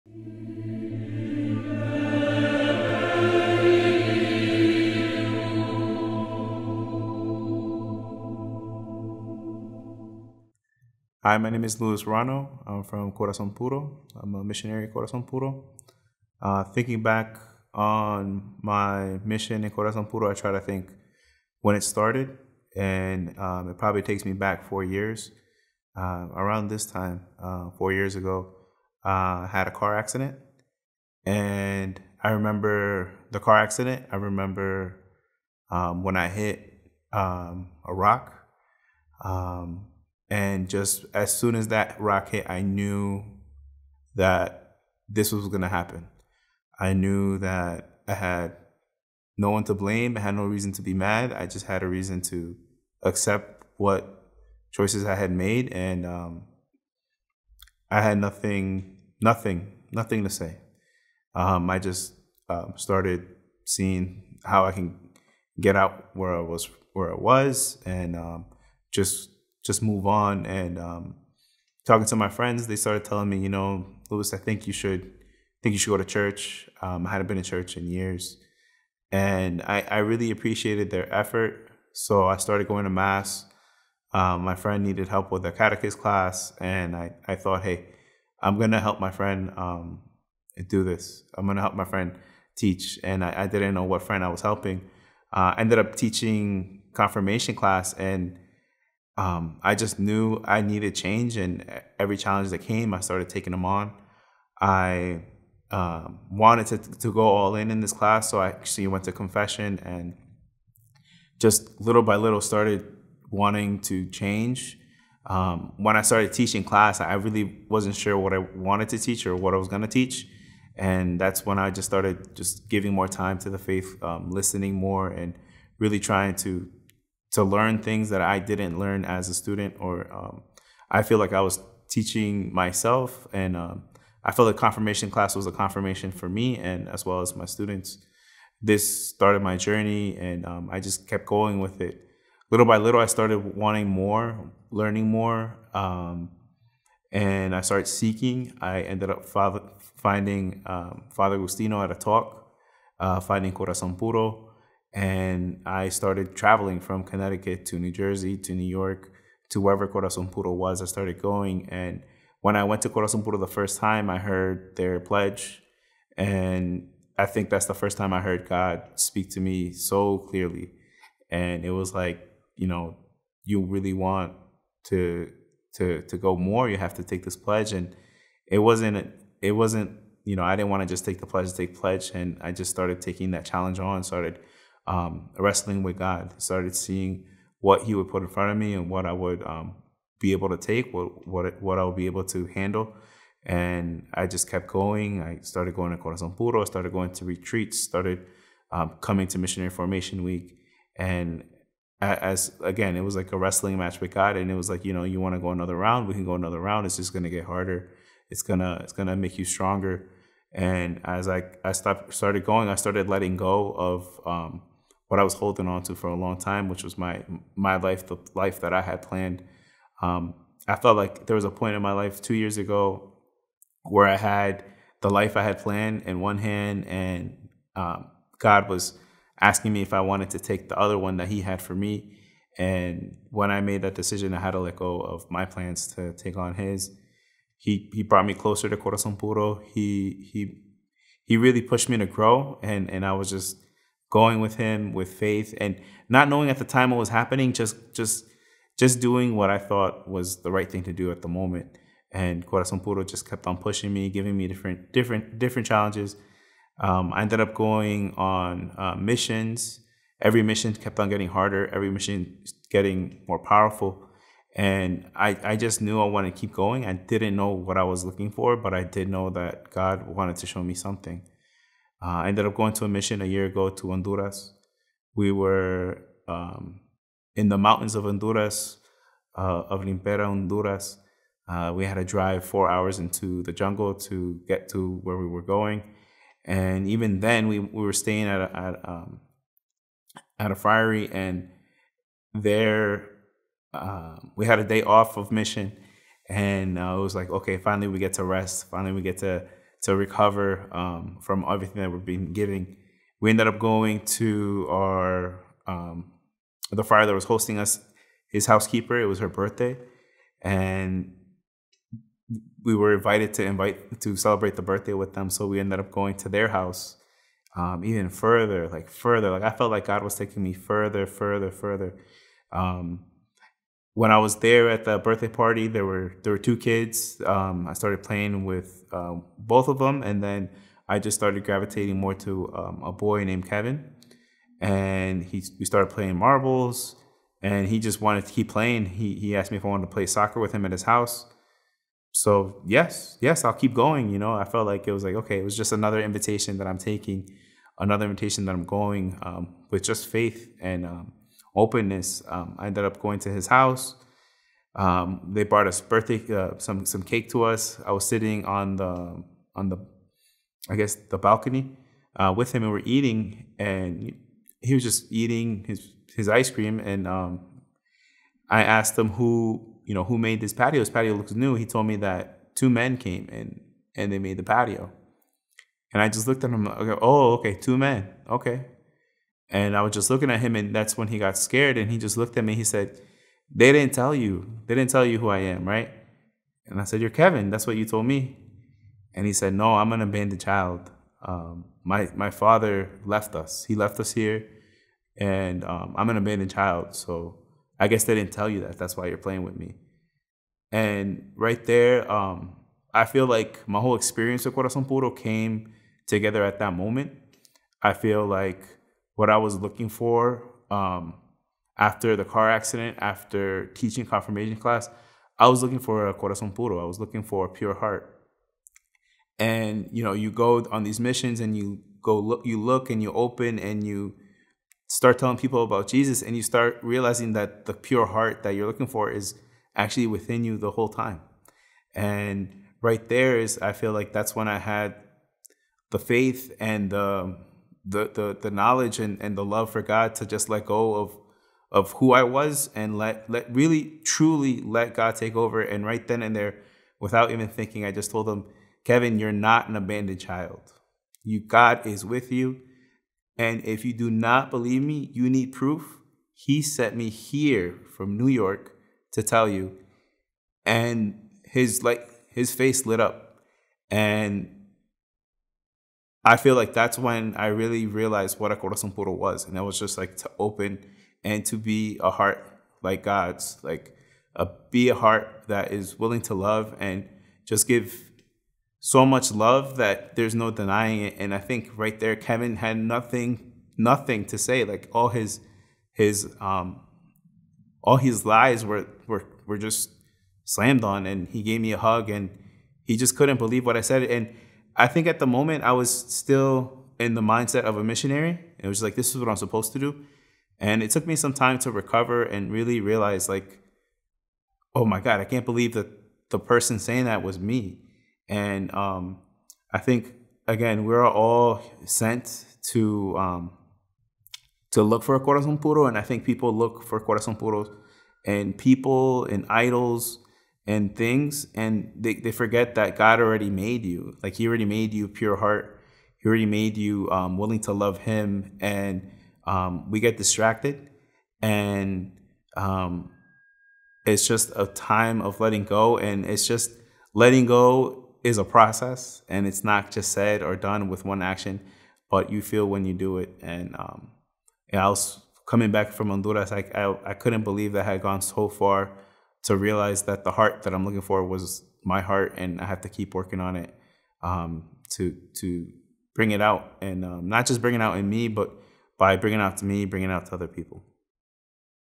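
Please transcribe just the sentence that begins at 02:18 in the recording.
This started my journey, and um, I just kept going with it.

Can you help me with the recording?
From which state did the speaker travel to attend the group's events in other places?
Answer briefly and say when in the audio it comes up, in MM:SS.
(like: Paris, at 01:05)
Connecticut, at 02:37.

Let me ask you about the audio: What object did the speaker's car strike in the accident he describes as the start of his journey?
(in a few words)
A rock.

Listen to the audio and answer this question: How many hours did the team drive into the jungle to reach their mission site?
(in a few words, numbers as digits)
4.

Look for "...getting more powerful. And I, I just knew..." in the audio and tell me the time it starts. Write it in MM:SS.
04:22.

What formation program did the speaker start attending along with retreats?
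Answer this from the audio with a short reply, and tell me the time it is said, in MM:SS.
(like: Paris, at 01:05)
Missionary Formation Week, at 03:19.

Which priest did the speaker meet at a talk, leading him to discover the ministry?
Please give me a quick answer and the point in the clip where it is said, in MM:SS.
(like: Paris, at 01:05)
Father Agustino, at 02:31.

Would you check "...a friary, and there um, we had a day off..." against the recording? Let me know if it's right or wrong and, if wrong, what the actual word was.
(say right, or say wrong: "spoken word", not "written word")
right.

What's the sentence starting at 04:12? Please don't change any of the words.
And Corazon Puro just kept on pushing me, giving me different different different challenges.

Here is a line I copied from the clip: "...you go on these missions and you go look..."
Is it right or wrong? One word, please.
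right.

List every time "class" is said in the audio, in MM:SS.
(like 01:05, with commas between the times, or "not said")
01:25, 01:37, 01:47, 01:56, 02:15, 06:54.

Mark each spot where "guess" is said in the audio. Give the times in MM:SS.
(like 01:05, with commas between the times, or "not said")
06:00, 06:37.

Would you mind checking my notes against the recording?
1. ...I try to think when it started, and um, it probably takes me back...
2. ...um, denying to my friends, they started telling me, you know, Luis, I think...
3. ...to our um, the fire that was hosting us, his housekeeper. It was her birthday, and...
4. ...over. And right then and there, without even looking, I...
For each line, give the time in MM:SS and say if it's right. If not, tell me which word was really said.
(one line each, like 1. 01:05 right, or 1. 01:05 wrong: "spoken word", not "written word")
1. 00:20 right
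2. 01:10 wrong: "talking", not "denying"
3. 05:04 right
4. 07:25 wrong: "thinking", not "looking".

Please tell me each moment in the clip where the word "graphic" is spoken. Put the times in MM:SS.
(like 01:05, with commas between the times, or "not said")
not said.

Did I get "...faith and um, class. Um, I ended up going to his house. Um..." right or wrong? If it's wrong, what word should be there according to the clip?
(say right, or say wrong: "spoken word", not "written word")
wrong: "openness", not "class".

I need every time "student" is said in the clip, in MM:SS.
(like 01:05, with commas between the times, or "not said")
02:09, 02:17.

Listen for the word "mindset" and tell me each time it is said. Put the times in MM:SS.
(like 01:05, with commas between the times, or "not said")
08:17.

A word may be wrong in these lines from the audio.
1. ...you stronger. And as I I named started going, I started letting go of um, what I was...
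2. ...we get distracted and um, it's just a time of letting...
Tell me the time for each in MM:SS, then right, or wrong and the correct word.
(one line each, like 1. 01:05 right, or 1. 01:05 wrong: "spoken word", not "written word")
1. 03:29 wrong: "stopped", not "named"
2. 08:49 right.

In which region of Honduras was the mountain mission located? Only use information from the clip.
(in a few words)
Lempira.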